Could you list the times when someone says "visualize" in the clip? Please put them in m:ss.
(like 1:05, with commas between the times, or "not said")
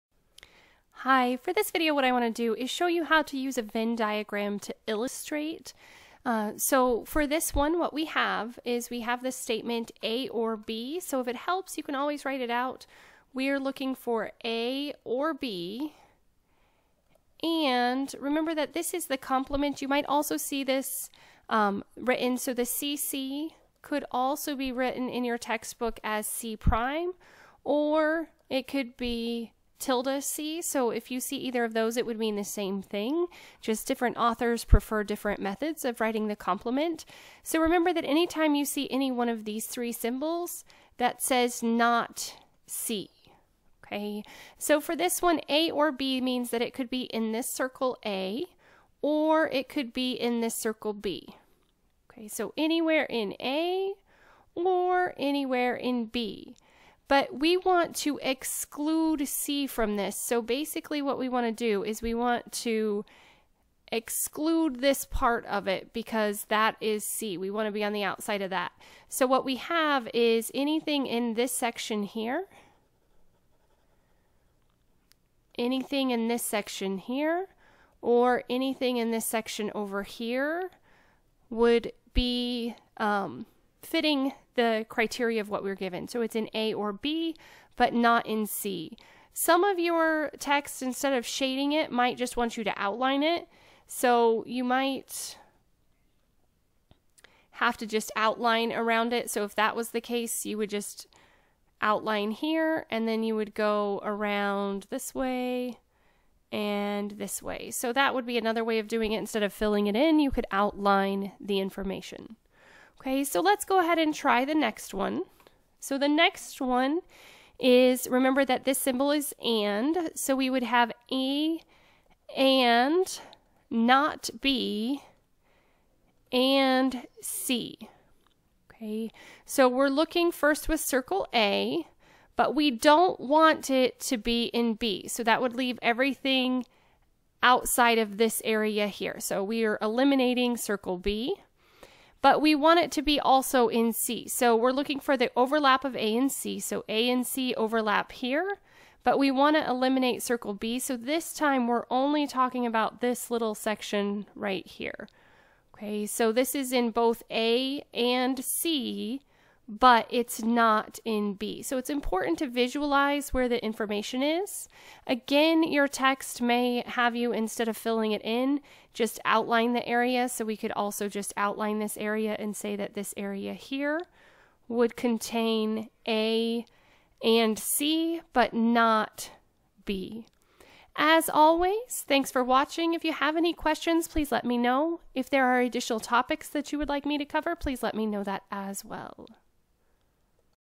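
2:42.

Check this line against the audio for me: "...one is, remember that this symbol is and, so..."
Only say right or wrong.
right.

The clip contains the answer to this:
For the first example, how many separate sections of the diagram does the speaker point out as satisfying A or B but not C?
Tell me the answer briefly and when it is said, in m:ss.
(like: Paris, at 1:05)
3, at 1:10.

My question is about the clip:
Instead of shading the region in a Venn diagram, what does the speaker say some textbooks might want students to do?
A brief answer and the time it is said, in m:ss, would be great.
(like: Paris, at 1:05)
outline it, at 1:32.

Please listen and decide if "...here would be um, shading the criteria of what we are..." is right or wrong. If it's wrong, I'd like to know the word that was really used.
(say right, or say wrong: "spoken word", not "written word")
wrong: "fitting", not "shading".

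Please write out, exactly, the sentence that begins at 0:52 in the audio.
Okay, so anywhere in A or anywhere in B.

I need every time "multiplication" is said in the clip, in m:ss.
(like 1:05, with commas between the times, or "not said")
not said.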